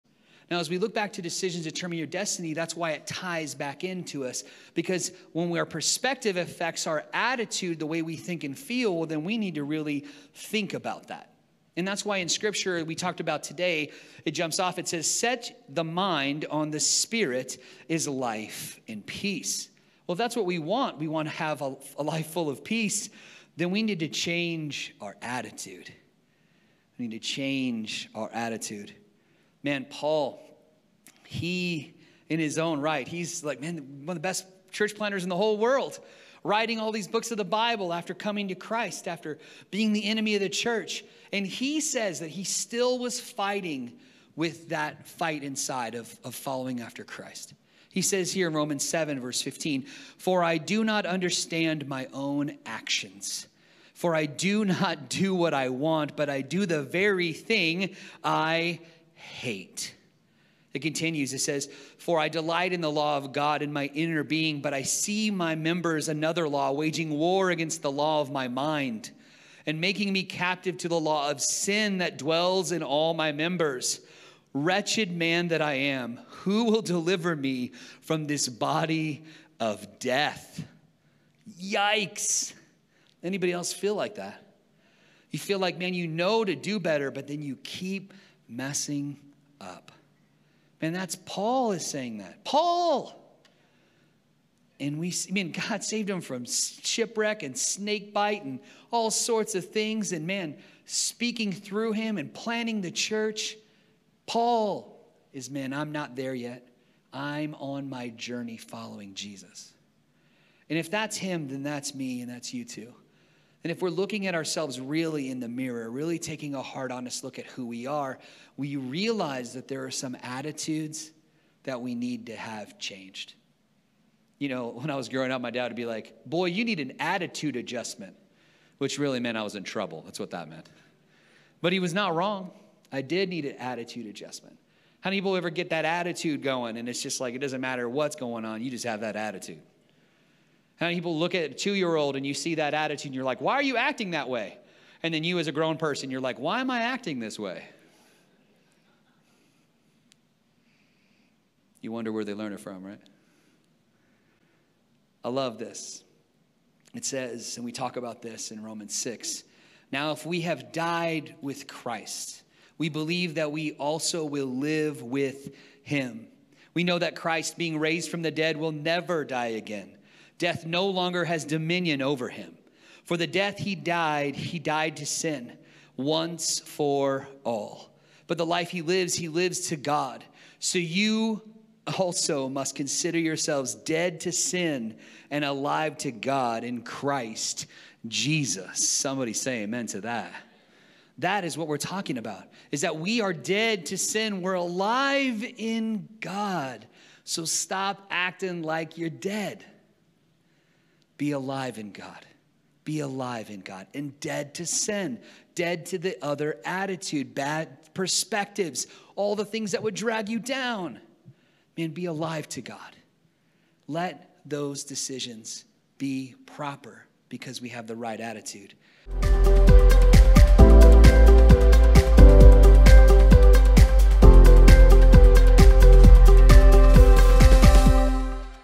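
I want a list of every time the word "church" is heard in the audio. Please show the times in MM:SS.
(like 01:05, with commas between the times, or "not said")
00:34, 00:40, 01:42.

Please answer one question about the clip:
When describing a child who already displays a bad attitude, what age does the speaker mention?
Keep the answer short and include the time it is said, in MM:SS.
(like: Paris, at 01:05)
2, at 02:21.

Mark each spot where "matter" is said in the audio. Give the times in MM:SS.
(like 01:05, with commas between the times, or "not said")
02:17.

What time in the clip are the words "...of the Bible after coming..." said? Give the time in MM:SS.
00:37.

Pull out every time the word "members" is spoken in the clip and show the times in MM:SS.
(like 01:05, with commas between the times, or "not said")
01:05, 01:13.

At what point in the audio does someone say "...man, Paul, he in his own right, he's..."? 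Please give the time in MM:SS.
00:29.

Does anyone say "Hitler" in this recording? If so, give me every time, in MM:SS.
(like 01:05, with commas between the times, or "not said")
not said.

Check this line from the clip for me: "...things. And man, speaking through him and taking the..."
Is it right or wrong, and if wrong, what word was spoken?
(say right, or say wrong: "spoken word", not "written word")
wrong: "planning", not "taking".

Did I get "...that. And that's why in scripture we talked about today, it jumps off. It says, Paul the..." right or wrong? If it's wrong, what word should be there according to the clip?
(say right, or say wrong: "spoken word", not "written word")
wrong: "Set", not "Paul".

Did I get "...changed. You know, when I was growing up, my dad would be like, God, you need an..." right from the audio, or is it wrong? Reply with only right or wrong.
wrong.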